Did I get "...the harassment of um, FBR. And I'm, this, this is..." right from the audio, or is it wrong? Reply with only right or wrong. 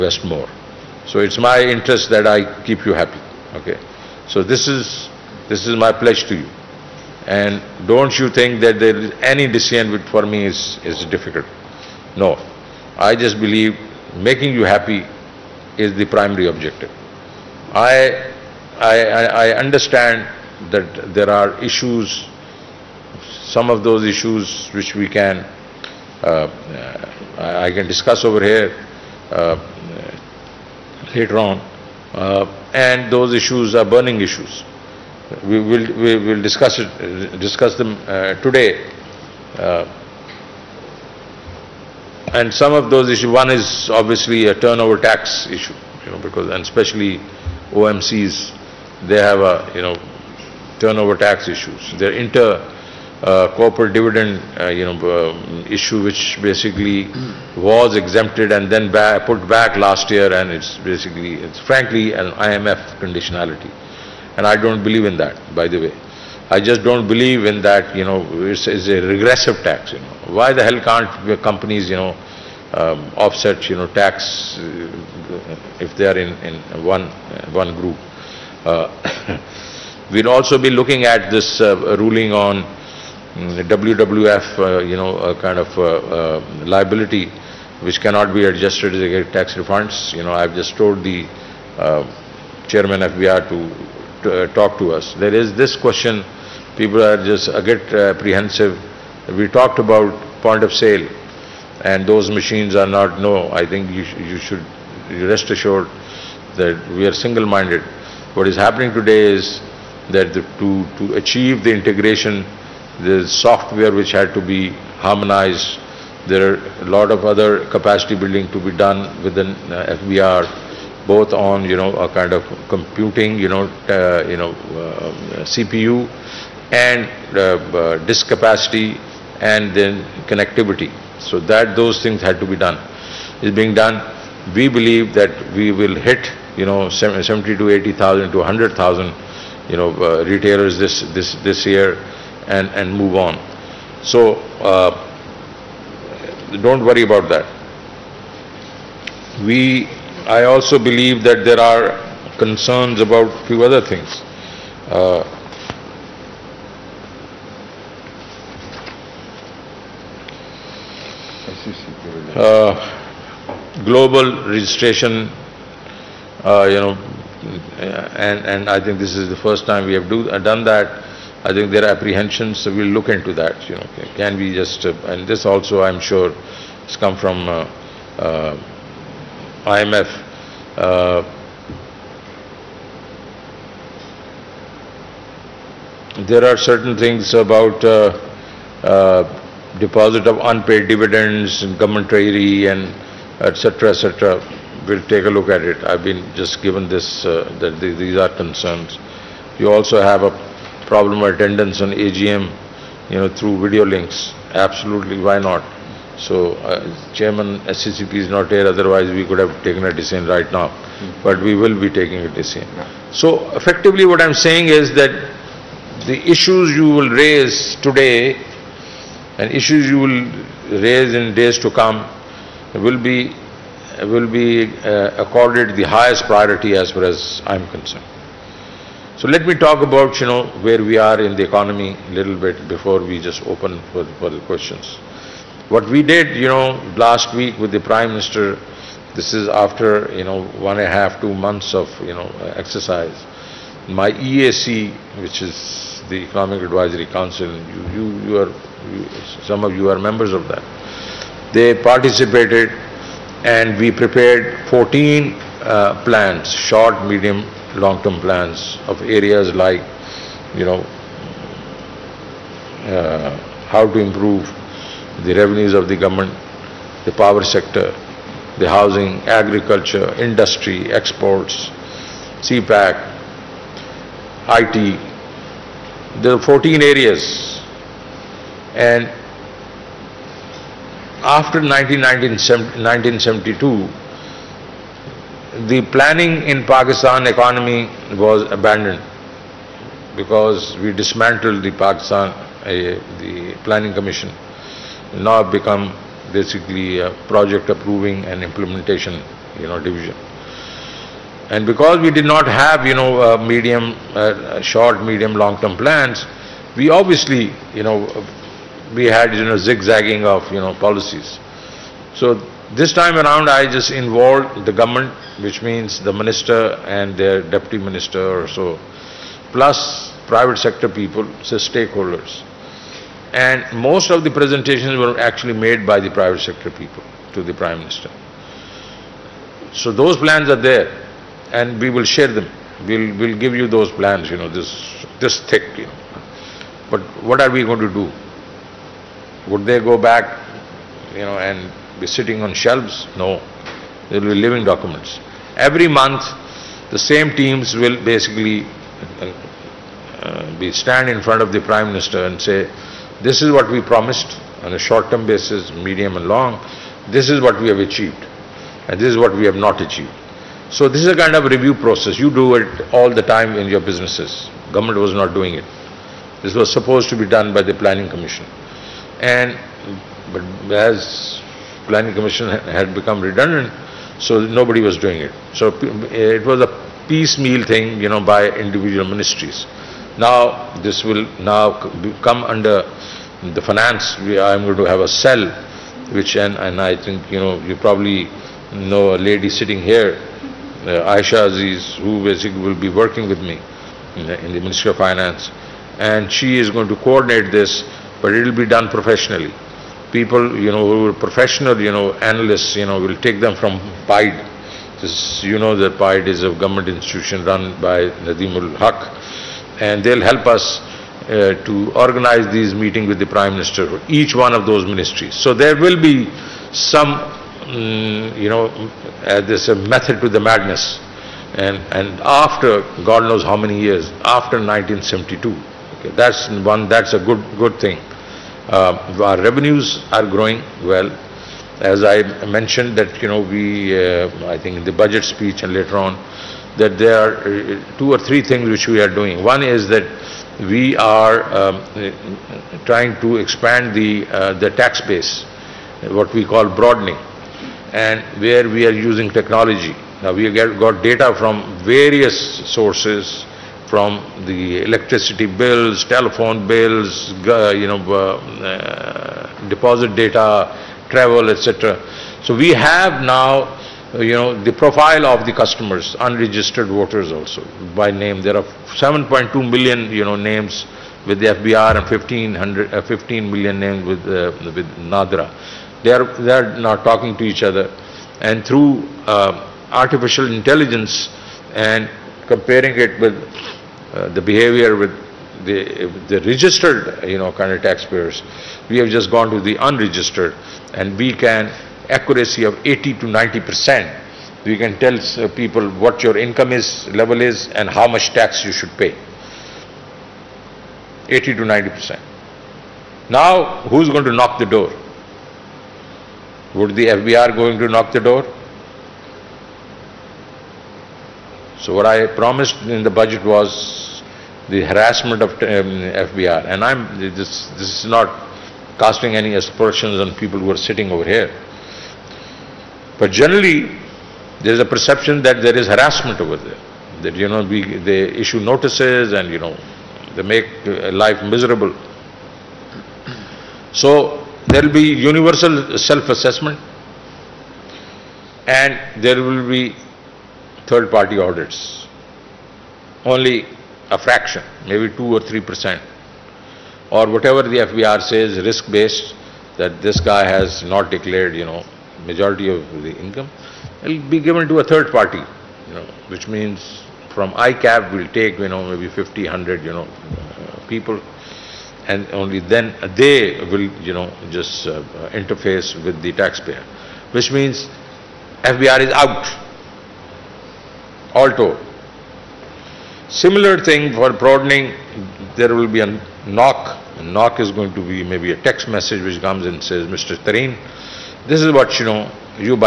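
right.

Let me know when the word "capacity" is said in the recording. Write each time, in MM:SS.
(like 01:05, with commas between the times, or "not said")
01:57, 02:08.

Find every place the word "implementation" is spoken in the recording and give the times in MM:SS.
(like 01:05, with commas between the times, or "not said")
04:58.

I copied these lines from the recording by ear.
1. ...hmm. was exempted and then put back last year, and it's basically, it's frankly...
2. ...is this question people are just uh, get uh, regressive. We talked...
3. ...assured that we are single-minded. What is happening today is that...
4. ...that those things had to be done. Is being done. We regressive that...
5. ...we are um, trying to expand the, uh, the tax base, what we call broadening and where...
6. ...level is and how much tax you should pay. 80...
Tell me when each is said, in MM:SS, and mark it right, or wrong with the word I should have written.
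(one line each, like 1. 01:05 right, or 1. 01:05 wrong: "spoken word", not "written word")
1. 00:57 right
2. 01:35 wrong: "apprehensive", not "regressive"
3. 01:45 right
4. 02:11 wrong: "believe", not "regressive"
5. 07:20 right
6. 08:17 right.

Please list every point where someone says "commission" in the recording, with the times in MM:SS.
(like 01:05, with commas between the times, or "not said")
04:53, 06:08, 06:12.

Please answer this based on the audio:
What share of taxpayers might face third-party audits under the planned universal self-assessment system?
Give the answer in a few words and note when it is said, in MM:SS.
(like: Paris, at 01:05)
2 or 3 percent, at 09:05.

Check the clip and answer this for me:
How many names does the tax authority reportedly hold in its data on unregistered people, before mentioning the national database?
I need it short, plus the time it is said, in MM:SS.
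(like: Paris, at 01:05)
7.2 million, at 07:48.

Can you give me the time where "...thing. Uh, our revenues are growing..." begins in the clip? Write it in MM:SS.
07:07.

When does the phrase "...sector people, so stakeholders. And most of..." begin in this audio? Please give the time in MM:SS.
05:20.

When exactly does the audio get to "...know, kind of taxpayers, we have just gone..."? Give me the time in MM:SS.
08:07.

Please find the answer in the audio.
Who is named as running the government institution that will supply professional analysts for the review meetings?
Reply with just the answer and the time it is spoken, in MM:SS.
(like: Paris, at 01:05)
Nadeem ul Haque, at 06:48.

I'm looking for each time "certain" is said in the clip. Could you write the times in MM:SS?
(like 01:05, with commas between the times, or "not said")
03:06.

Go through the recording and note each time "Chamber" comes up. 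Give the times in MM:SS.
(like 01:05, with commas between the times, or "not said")
not said.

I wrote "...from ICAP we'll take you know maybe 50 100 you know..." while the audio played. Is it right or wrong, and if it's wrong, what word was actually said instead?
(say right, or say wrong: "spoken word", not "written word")
right.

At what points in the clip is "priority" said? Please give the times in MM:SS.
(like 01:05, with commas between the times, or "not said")
03:46.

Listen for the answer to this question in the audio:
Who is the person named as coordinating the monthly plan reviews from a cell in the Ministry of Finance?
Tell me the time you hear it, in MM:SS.
06:31.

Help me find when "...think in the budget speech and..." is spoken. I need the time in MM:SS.
07:14.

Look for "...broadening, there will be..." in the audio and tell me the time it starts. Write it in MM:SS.
09:34.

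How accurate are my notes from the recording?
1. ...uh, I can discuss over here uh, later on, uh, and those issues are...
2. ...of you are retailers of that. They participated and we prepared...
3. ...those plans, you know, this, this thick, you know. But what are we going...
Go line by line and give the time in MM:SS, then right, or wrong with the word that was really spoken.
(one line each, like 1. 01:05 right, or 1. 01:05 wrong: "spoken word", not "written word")
1. 00:26 right
2. 04:09 wrong: "members", not "retailers"
3. 05:33 right.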